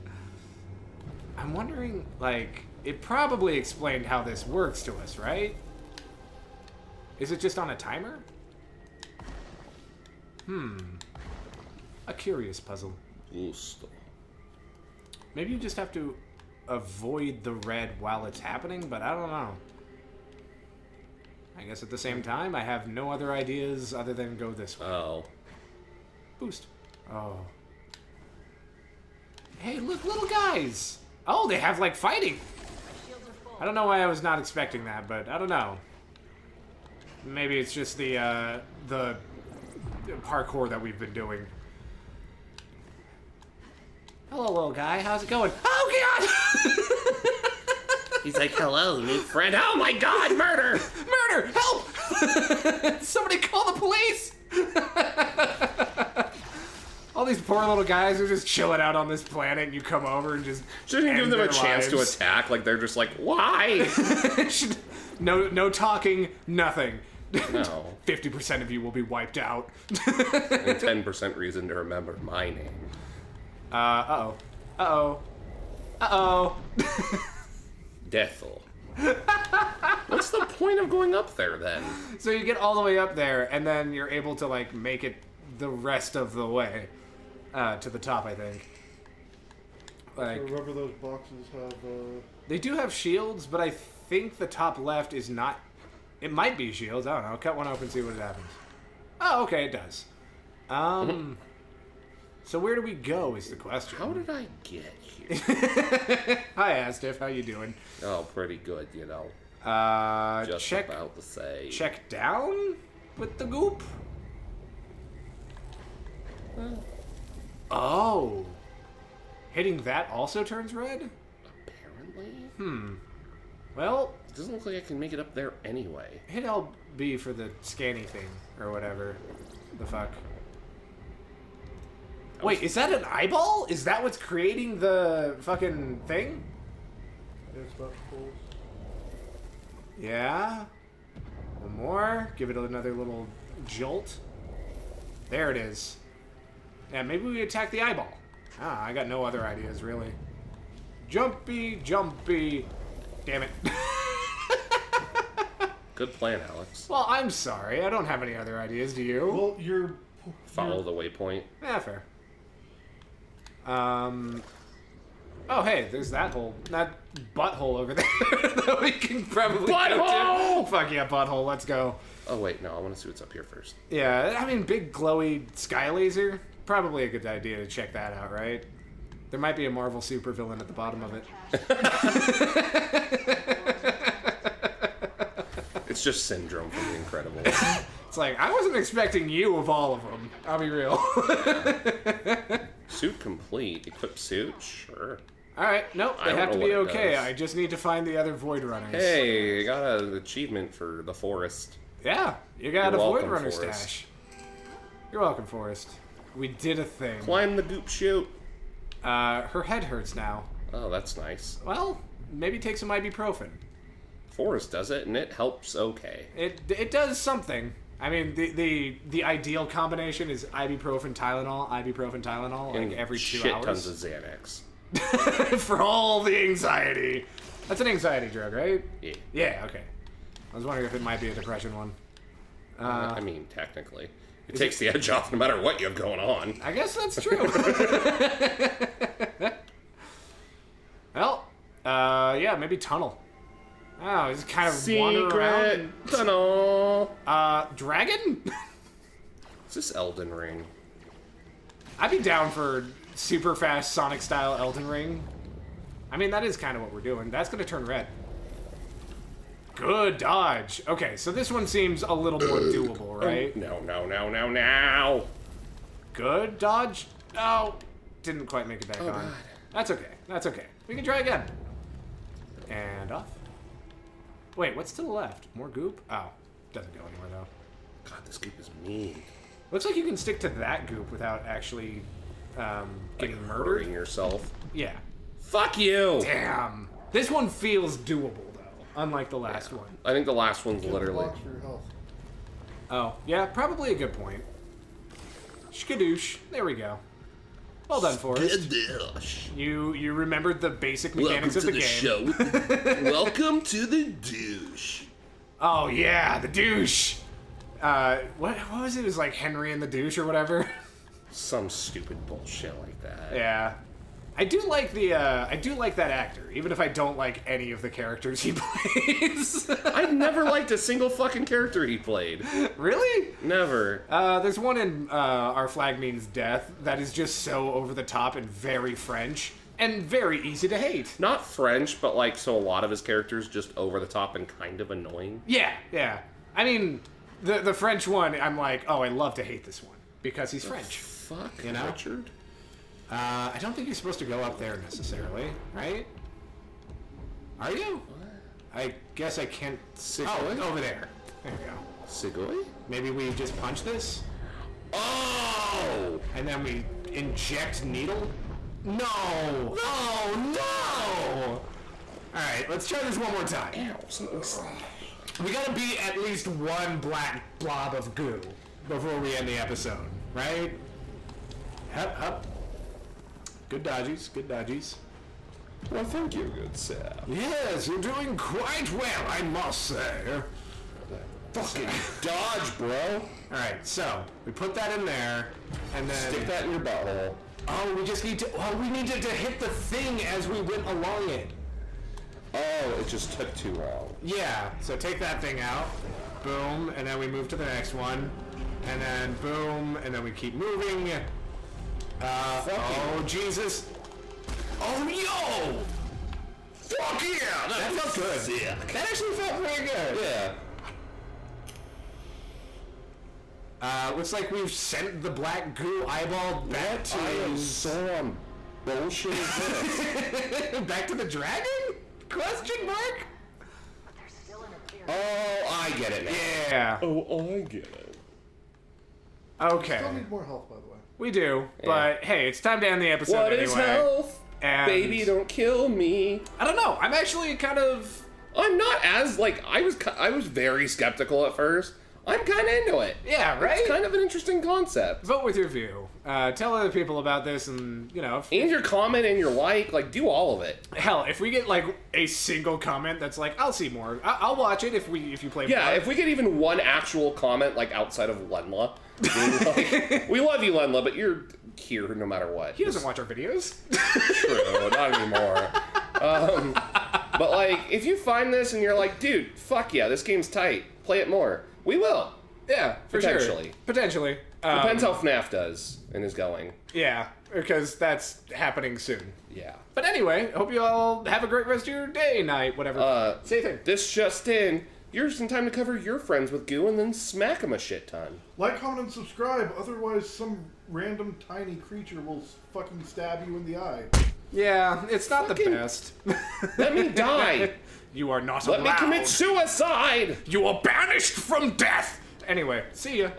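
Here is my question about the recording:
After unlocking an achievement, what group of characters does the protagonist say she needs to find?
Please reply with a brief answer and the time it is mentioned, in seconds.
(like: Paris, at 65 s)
Void Runners, at 198 s.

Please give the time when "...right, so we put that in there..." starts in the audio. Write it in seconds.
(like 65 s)
383 s.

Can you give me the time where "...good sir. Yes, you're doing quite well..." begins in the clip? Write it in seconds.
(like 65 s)
376 s.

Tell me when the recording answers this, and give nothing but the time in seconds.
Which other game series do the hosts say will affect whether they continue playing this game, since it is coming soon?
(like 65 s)
475 s.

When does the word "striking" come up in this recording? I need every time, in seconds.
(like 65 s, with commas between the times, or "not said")
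not said.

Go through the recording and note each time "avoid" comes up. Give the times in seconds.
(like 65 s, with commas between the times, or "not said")
16 s.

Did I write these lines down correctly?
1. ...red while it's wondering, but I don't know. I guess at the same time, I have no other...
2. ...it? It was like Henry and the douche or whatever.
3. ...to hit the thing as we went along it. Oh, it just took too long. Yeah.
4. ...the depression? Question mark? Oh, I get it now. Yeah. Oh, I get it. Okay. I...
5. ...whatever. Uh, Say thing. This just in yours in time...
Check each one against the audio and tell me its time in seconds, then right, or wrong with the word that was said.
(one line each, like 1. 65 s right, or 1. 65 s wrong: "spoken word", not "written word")
1. 17 s wrong: "happening", not "wondering"
2. 308 s right
3. 389 s right
4. 421 s wrong: "dragon", not "depression"
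5. 482 s right.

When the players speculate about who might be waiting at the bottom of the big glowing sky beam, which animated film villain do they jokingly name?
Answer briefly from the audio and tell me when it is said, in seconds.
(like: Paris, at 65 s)
Syndrome, at 186 s.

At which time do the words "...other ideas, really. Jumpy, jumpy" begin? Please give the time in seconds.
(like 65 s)
149 s.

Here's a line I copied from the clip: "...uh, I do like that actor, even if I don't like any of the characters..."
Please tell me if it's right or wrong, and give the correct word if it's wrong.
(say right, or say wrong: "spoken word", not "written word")
right.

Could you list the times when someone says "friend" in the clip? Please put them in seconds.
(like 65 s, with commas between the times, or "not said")
49 s, 486 s.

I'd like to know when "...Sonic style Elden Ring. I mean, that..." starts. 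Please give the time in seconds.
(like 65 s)
253 s.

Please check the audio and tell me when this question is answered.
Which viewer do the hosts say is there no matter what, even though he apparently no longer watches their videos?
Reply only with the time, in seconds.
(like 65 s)
458 s.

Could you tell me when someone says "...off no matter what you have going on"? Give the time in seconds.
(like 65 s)
235 s.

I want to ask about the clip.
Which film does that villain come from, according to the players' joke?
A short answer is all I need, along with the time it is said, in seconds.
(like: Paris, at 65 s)
The Incredibles, at 186 s.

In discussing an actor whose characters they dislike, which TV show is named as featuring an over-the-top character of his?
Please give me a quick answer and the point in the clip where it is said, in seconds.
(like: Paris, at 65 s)
Our Flag Means Death, at 325 s.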